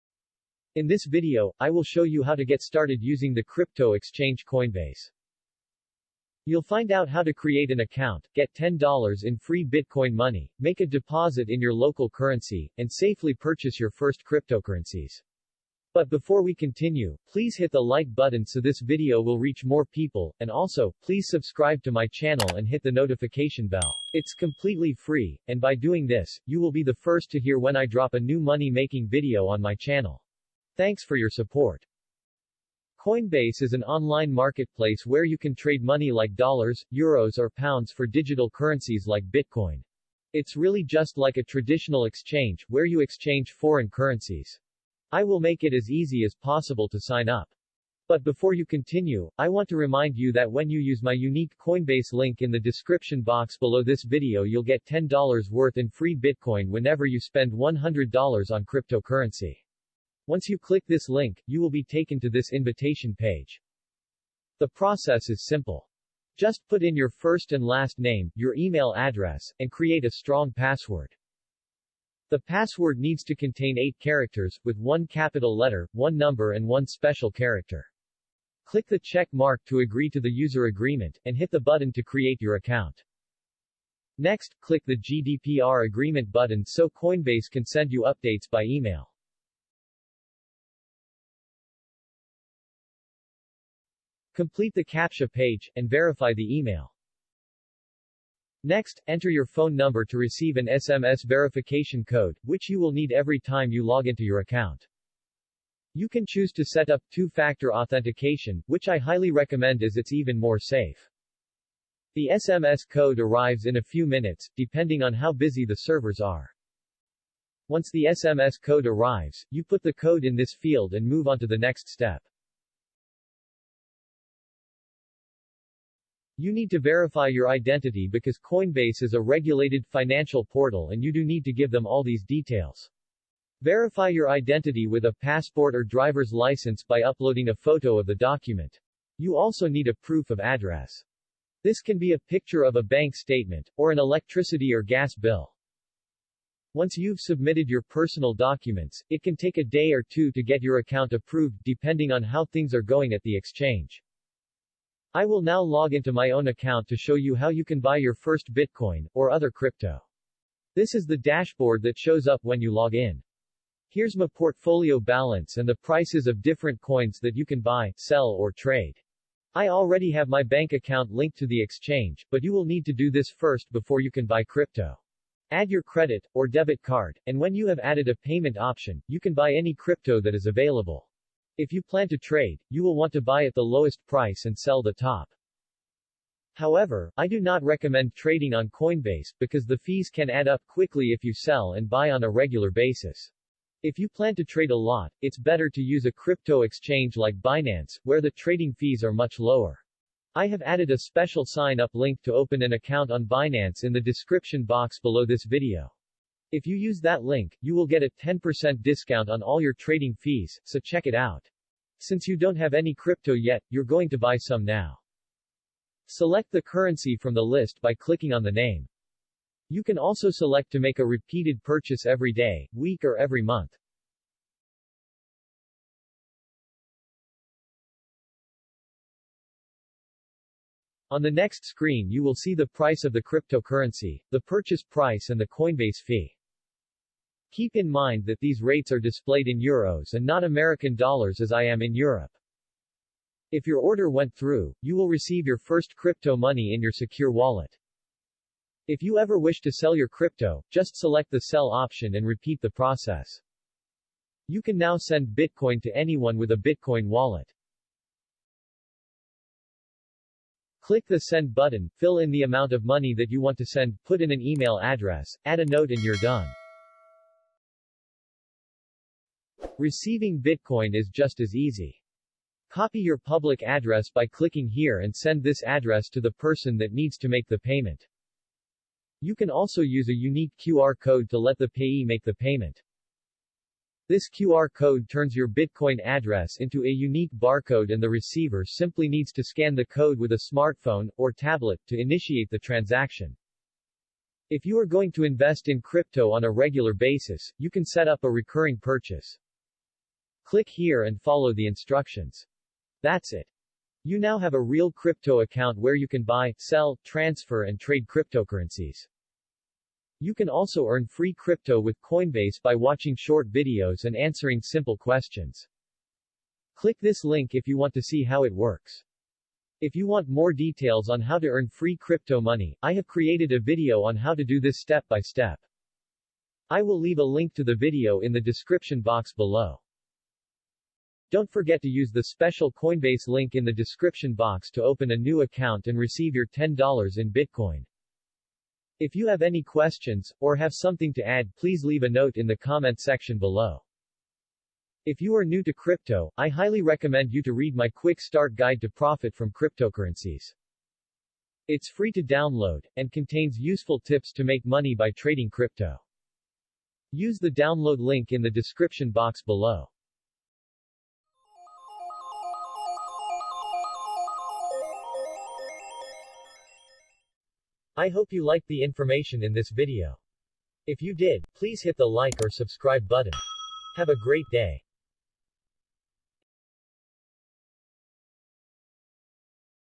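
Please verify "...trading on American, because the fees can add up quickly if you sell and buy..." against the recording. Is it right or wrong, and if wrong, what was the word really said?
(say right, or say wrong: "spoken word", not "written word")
wrong: "Coinbase", not "American".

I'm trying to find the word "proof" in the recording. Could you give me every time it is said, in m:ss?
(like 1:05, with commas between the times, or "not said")
2:19.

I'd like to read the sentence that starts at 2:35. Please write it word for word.
I will now log into my own account to show you how you can buy your first Bitcoin, or other crypto.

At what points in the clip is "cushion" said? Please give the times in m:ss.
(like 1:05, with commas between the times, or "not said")
not said.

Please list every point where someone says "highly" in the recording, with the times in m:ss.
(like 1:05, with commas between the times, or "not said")
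1:48, 5:46.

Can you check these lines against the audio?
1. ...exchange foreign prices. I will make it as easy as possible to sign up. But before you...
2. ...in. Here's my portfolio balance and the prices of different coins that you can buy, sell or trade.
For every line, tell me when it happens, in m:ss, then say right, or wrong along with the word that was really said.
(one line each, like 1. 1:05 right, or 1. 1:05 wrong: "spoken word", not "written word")
1. 0:43 wrong: "currencies", not "prices"
2. 2:42 right.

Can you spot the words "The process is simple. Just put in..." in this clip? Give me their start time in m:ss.
1:04.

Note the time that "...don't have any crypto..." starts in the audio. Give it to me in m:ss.
3:32.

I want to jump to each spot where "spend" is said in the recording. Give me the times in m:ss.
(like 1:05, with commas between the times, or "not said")
0:57.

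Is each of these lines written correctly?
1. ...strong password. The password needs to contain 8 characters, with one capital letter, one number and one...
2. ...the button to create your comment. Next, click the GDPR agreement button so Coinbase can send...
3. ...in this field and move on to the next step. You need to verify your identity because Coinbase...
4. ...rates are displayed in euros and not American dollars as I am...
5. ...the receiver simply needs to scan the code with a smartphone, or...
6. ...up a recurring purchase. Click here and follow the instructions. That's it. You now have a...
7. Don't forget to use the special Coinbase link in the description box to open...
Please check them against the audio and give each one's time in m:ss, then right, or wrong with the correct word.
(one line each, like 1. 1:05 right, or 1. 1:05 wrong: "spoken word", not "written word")
1. 1:10 right
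2. 1:21 wrong: "account", not "comment"
3. 2:00 right
4. 3:58 right
5. 4:48 right
6. 4:58 right
7. 5:31 right.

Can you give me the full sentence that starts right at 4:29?
Receiving Bitcoin is just as easy.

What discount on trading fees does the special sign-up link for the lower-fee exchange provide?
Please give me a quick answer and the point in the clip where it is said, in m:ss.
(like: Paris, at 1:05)
10%, at 3:28.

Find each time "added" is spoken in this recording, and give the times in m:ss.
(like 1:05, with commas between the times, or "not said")
2:57, 3:20.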